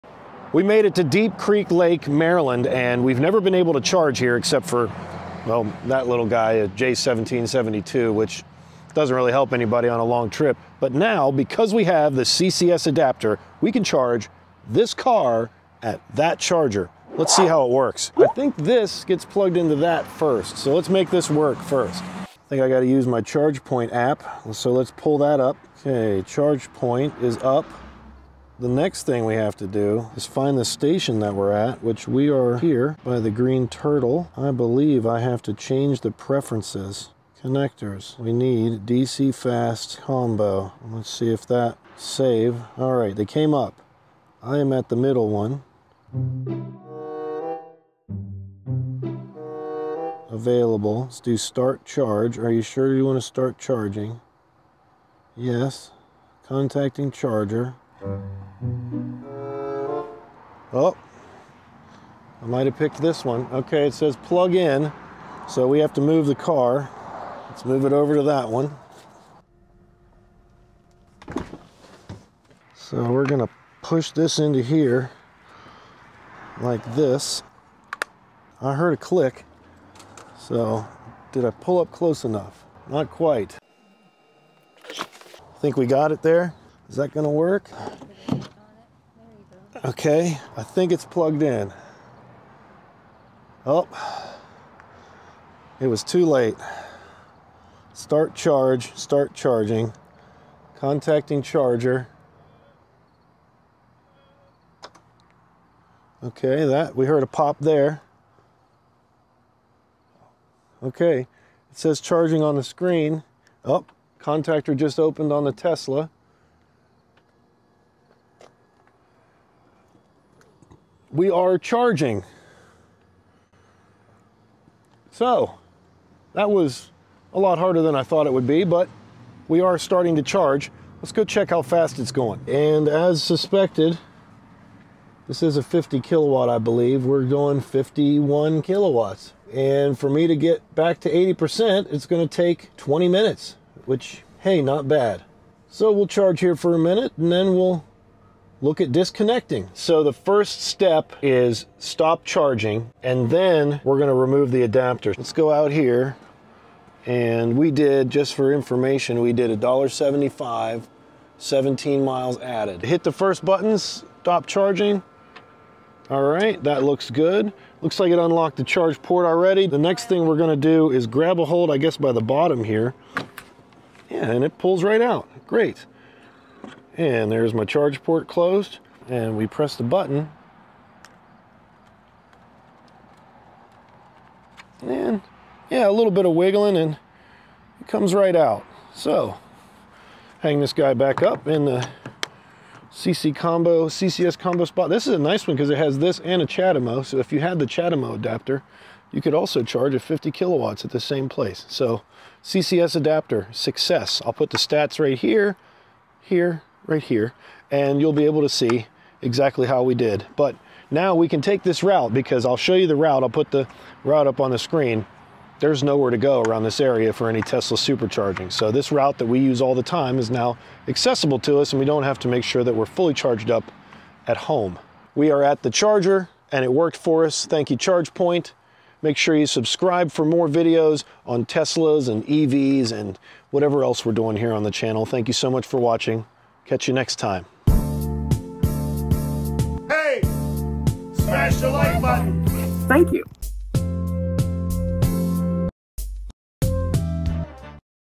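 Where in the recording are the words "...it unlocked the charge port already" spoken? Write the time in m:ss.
2:48.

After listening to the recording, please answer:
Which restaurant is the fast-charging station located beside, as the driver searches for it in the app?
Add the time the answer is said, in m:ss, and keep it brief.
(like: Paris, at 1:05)
The Greene Turtle, at 0:33.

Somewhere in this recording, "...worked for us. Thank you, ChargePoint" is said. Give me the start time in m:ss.
3:46.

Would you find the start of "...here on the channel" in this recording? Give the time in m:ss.
3:54.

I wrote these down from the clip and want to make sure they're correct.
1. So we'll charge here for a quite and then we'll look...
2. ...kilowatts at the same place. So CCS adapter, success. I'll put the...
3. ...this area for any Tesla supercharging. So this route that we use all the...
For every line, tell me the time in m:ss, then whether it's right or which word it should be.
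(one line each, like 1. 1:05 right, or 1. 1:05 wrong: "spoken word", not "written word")
1. 2:25 wrong: "minute", not "quite"
2. 3:20 right
3. 3:36 right.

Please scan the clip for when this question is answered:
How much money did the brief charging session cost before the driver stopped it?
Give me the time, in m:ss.
2:39.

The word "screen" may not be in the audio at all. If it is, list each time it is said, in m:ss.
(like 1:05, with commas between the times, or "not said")
1:52, 3:34.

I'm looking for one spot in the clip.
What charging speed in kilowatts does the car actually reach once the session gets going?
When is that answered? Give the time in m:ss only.
2:17.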